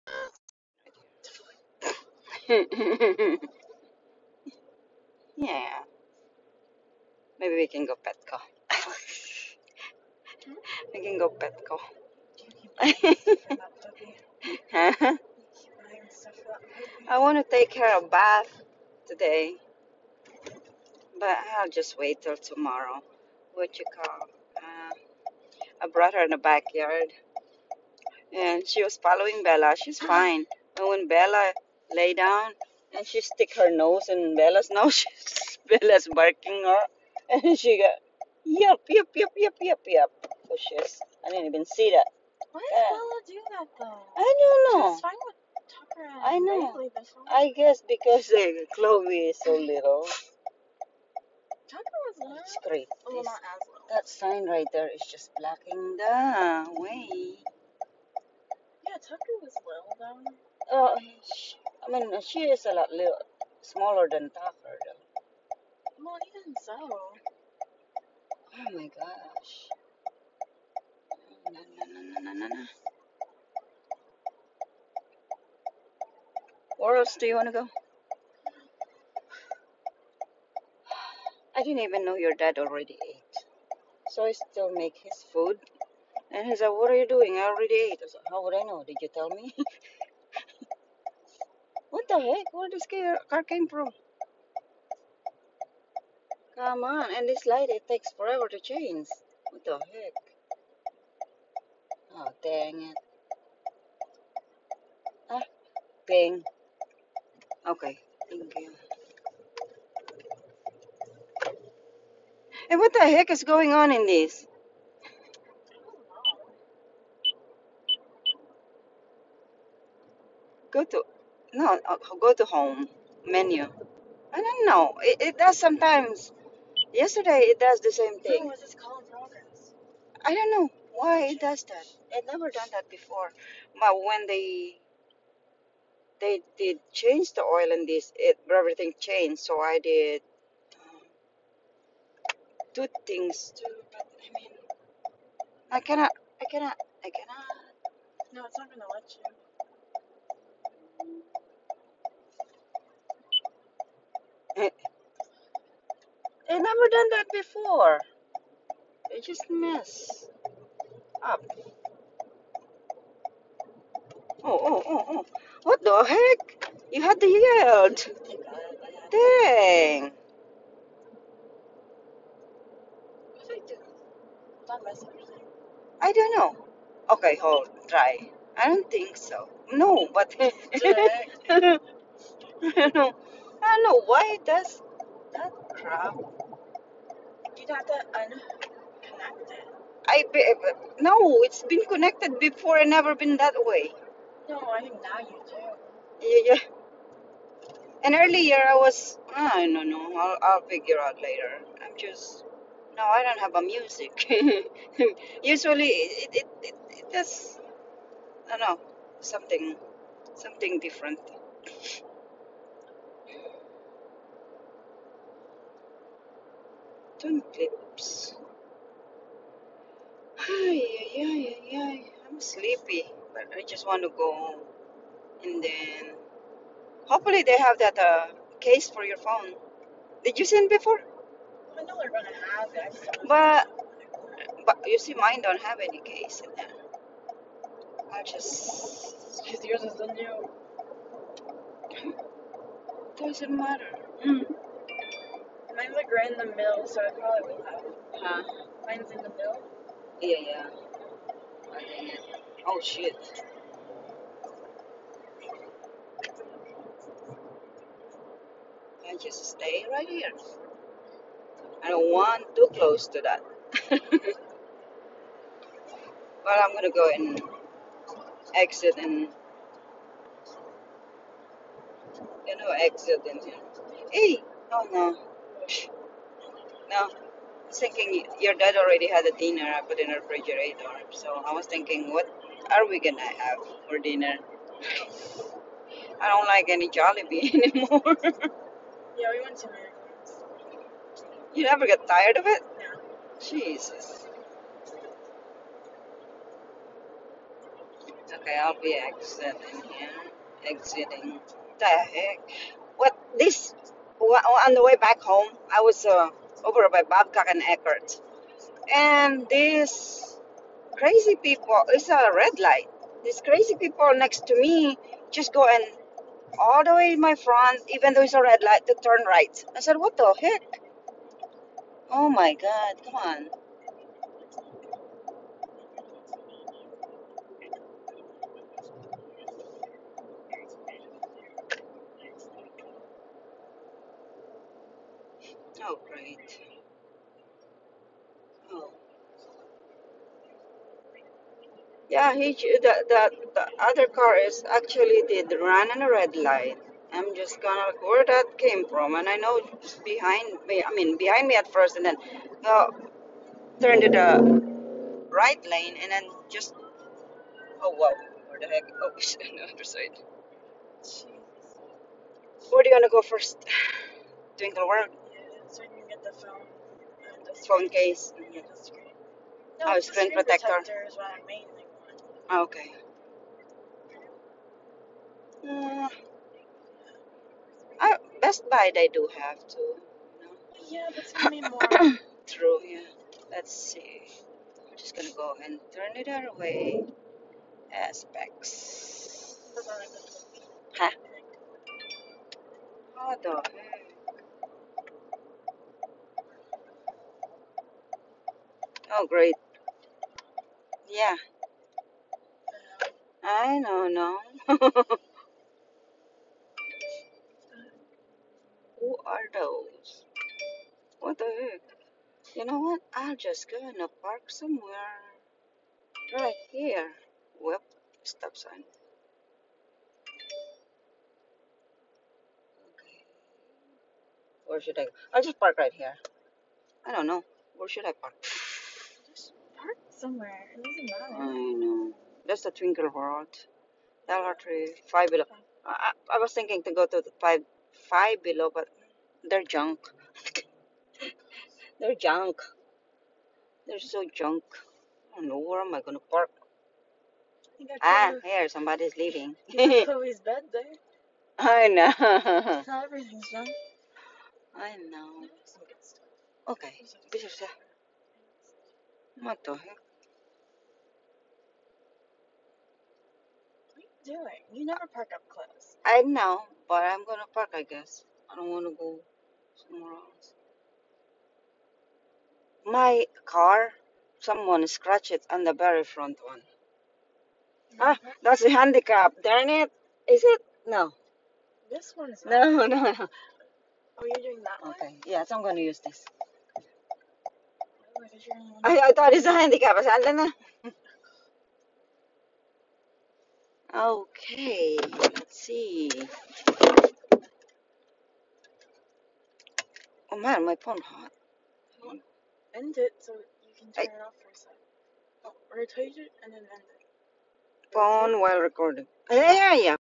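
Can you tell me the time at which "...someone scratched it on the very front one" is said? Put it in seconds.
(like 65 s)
474 s.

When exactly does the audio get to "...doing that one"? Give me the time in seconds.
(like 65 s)
484 s.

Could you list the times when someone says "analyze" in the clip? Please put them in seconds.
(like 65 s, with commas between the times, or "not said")
not said.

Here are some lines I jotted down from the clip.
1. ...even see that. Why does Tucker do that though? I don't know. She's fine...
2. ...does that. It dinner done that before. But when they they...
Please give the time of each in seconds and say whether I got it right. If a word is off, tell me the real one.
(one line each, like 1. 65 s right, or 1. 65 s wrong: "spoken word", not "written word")
1. 41 s wrong: "Bella", not "Tucker"
2. 131 s wrong: "never", not "dinner".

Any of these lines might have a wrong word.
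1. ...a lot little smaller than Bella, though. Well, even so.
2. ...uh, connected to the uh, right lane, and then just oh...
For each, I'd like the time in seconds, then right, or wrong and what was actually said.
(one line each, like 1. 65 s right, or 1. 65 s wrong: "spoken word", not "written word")
1. 62 s wrong: "Tucker", not "Bella"
2. 352 s wrong: "turned", not "connected".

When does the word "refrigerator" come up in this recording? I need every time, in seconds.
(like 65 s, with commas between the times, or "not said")
280 s.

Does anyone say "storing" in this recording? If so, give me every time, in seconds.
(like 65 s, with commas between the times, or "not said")
not said.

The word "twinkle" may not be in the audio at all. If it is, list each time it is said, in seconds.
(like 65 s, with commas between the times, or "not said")
364 s, 432 s.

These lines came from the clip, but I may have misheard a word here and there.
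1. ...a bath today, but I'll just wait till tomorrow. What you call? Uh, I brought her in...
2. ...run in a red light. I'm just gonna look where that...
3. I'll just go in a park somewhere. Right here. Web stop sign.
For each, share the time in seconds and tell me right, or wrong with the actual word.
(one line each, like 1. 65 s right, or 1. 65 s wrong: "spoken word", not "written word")
1. 17 s right
2. 345 s right
3. 413 s right.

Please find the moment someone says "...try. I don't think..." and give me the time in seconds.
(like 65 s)
177 s.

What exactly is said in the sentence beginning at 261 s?
I don't want too close to that.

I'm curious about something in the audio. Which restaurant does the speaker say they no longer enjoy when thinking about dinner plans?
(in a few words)
Jollibee.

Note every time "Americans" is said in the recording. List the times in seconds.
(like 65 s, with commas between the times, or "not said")
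289 s.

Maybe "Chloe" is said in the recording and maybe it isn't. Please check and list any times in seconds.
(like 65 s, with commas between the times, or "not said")
48 s, 449 s.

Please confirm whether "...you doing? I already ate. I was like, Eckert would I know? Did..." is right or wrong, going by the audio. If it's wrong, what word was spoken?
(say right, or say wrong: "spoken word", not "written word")
wrong: "How", not "Eckert".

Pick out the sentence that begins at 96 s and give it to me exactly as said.
Come on, and this light, it takes forever to change.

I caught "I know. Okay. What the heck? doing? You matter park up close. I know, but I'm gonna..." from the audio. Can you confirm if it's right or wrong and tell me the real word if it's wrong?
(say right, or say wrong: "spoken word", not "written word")
wrong: "never", not "matter".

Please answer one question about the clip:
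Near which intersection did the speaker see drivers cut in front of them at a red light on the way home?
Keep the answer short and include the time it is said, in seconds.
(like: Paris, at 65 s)
Babcock and Eckert, at 307 s.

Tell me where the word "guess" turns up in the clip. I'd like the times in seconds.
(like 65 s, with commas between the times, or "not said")
47 s, 467 s.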